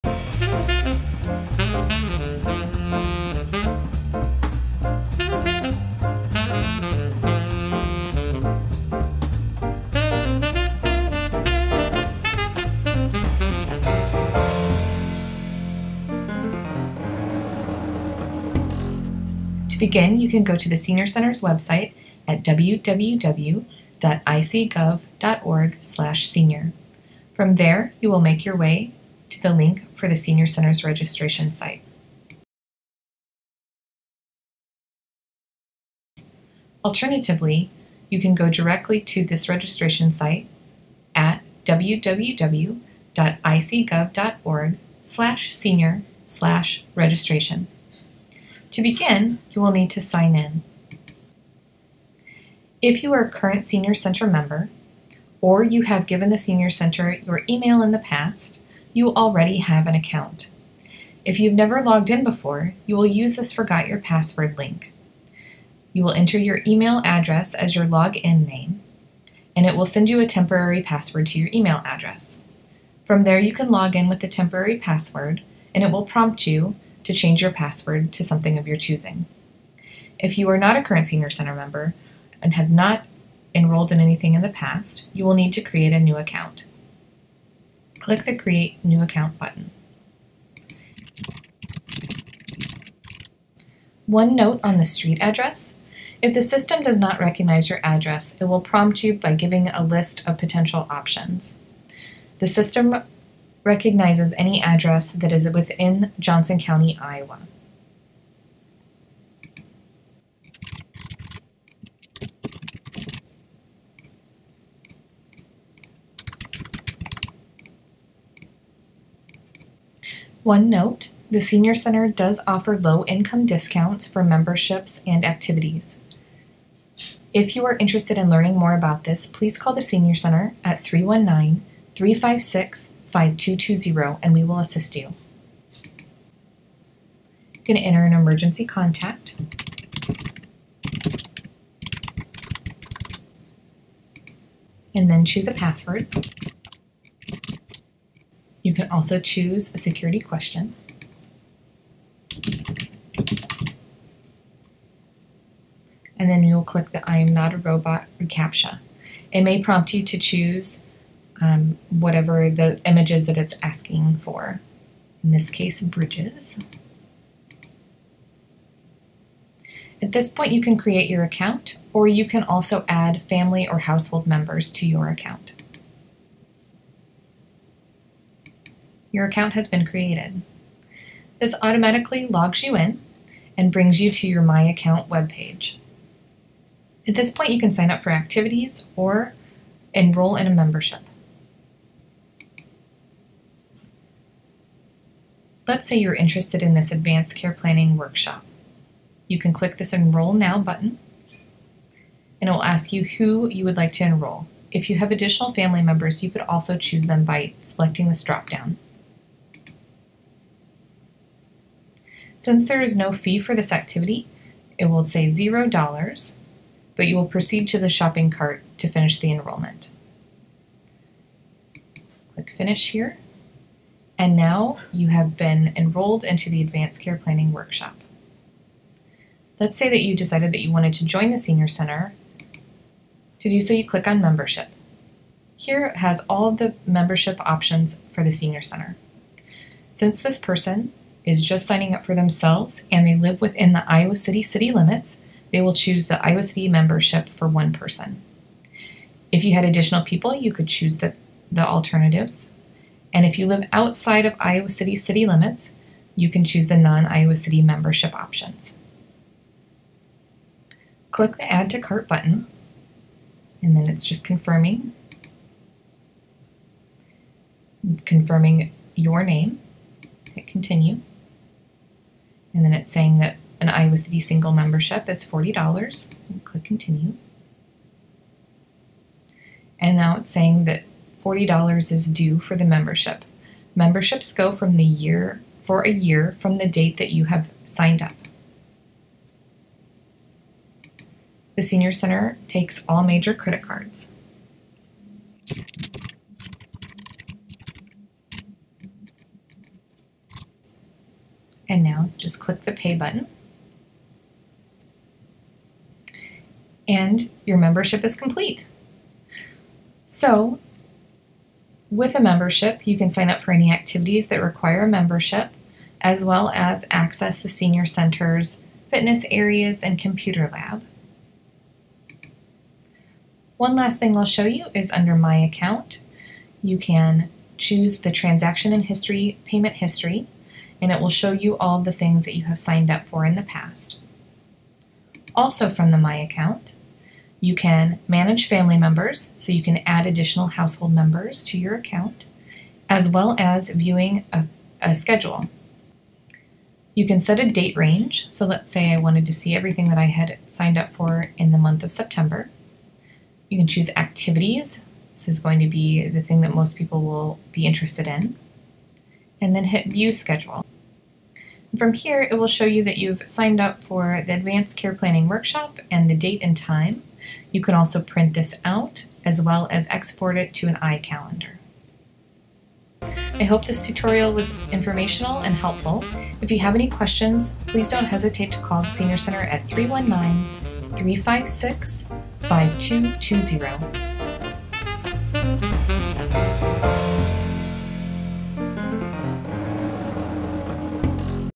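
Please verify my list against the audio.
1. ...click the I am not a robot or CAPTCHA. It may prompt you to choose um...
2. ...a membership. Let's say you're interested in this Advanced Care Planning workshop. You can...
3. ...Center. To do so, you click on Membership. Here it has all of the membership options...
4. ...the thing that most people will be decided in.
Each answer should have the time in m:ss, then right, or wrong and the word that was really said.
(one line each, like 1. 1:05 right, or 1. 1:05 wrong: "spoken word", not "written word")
1. 2:36 right
2. 3:10 right
3. 3:51 right
4. 5:56 wrong: "interested", not "decided".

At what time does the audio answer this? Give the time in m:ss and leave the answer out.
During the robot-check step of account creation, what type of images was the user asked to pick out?
2:45.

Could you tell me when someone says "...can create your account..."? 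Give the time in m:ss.
2:50.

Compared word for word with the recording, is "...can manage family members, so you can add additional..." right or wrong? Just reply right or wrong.
right.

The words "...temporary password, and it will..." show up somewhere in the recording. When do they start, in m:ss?
1:14.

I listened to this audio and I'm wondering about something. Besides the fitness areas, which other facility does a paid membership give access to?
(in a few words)
Computer lab.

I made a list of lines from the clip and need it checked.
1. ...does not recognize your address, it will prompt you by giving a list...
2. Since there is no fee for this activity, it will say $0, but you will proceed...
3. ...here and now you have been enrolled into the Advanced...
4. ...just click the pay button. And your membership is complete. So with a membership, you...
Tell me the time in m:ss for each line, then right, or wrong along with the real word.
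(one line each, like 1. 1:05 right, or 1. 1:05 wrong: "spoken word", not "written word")
1. 1:36 right
2. 3:32 right
3. 3:42 right
4. 5:02 right.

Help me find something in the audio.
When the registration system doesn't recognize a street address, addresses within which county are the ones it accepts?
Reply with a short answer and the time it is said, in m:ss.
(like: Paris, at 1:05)
Johnson County, Iowa, at 1:46.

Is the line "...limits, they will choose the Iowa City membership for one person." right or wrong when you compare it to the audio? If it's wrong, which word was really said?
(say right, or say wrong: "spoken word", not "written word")
right.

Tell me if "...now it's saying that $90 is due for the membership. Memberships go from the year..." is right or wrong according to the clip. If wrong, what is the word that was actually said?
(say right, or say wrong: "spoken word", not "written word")
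wrong: "40", not "90".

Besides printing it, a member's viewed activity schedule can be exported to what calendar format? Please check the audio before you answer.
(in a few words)
iCalendar.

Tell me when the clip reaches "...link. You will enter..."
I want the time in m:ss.
1:04.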